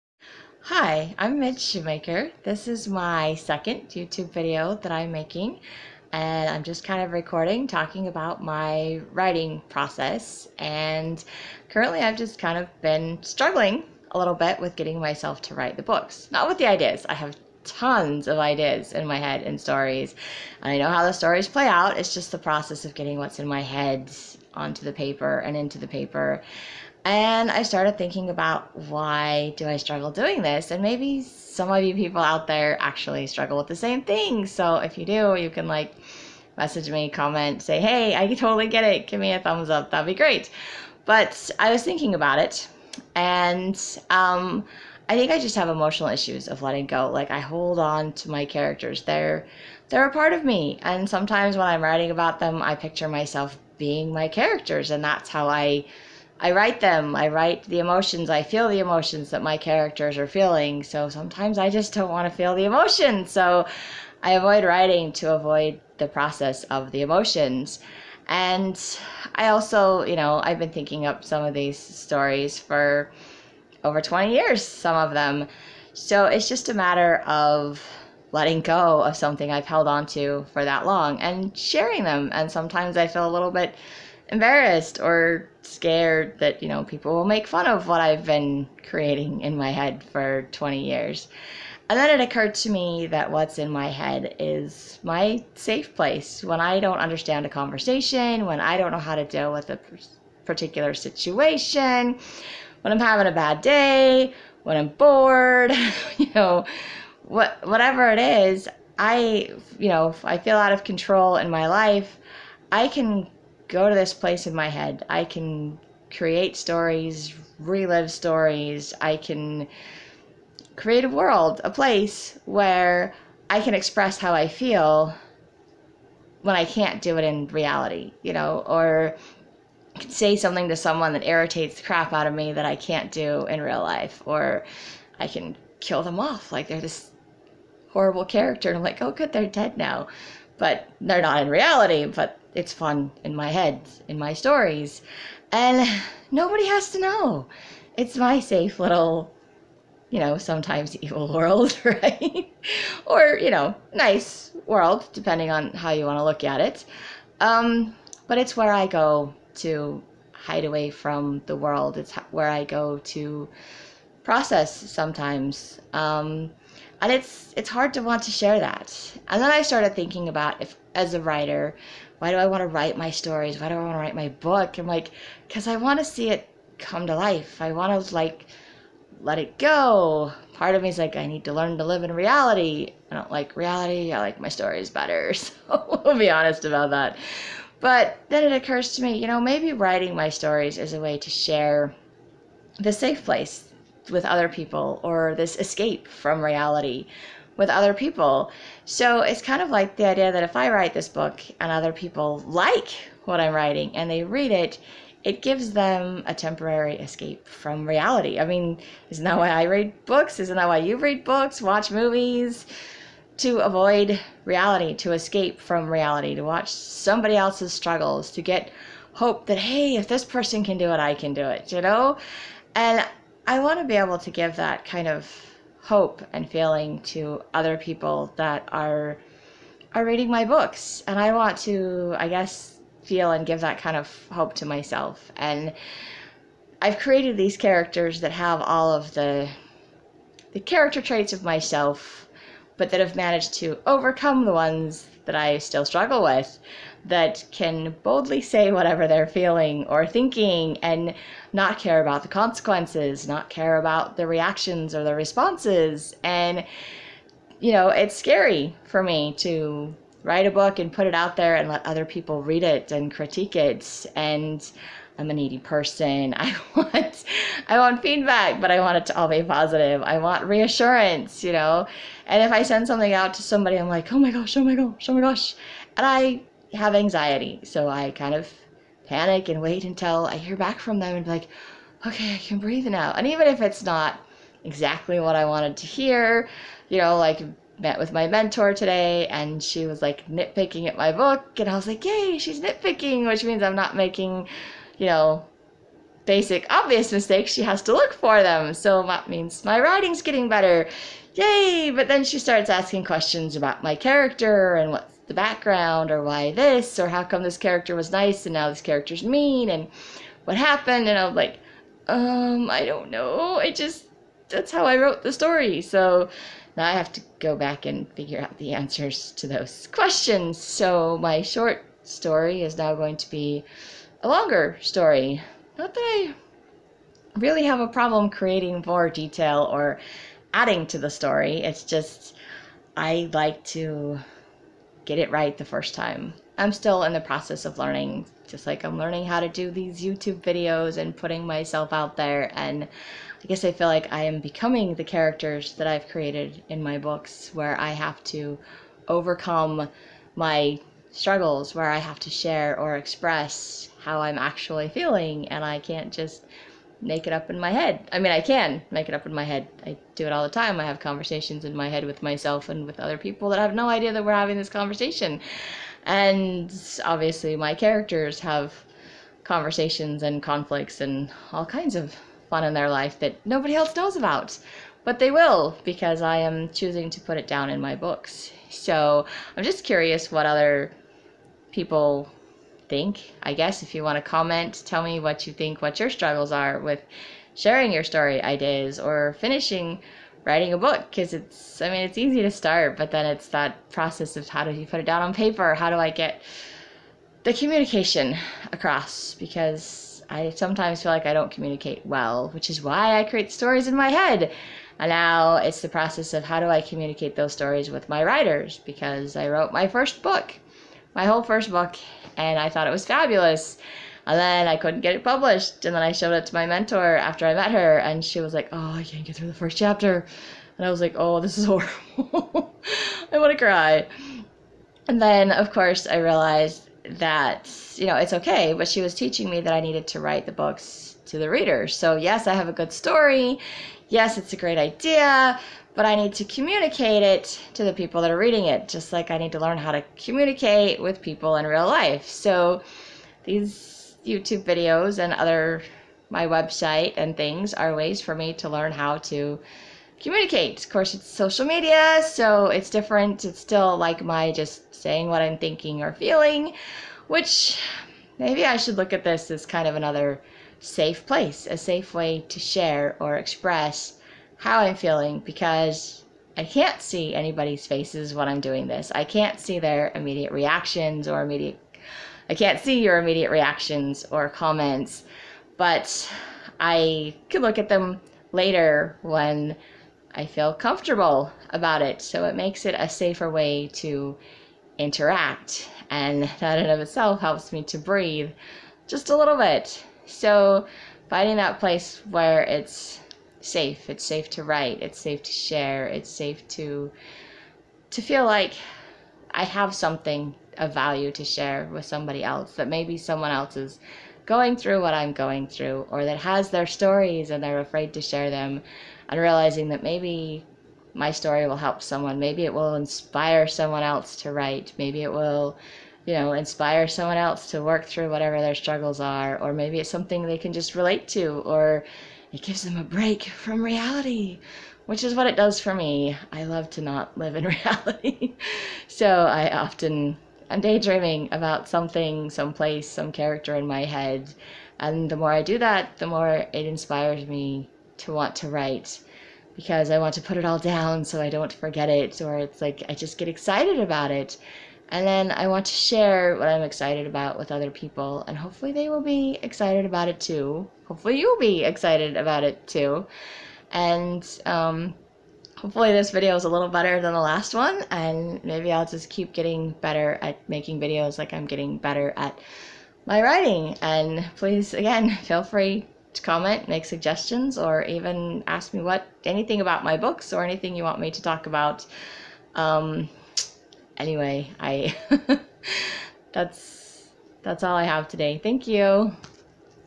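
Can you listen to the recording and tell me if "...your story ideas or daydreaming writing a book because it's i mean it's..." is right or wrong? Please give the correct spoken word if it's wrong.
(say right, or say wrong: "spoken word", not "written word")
wrong: "finishing", not "daydreaming".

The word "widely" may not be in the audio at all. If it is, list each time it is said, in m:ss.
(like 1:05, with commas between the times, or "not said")
not said.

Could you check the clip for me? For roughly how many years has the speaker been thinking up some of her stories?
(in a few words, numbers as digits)
20.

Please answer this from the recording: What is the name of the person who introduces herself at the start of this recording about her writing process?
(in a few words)
Midge Shoemaker.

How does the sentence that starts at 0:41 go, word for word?
But I was thinking about it.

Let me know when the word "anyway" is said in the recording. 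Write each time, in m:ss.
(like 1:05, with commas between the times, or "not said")
9:34.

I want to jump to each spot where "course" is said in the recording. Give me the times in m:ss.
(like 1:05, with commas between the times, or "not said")
7:05, 7:30.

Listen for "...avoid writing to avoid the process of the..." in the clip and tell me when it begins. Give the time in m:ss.
1:04.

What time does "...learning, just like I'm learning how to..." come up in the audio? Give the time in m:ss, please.
5:37.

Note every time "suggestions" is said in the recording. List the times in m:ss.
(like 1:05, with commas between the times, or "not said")
9:27.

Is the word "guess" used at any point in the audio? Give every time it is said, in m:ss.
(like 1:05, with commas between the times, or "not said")
3:52, 5:43, 6:23.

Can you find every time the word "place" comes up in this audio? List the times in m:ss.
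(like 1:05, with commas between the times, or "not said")
1:35, 1:54, 2:01, 3:13, 7:41, 8:11, 8:52.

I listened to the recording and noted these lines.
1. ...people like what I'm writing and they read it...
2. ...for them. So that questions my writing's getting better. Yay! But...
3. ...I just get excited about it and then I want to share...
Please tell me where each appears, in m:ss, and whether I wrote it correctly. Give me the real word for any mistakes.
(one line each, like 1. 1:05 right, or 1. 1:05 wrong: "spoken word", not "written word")
1. 3:21 right
2. 4:58 wrong: "means", not "questions"
3. 9:03 right.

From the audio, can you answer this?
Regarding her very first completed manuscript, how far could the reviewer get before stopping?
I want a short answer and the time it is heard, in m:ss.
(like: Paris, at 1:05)
First chapter, at 6:59.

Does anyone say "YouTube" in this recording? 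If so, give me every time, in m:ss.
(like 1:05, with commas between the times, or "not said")
0:03, 5:40, 7:24.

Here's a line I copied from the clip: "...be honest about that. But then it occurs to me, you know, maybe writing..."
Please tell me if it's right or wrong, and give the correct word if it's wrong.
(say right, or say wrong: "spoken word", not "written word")
right.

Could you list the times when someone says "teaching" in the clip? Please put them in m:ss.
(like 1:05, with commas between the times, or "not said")
7:09.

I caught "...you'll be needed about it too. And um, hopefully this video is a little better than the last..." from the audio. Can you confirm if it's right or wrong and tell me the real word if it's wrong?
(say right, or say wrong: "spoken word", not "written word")
wrong: "excited", not "needed".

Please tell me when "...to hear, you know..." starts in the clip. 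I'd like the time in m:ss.
4:45.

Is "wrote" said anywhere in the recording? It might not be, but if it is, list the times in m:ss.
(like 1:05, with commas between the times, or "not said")
5:14, 6:49.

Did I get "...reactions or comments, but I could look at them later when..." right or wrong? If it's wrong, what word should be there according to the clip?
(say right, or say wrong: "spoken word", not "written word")
right.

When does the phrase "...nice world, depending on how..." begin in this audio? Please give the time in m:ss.
2:33.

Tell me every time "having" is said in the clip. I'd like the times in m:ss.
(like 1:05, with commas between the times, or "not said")
1:42, 6:04.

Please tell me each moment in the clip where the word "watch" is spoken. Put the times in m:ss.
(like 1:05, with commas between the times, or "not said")
3:31, 3:36.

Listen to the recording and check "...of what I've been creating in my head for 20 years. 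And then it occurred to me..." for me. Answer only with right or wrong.
right.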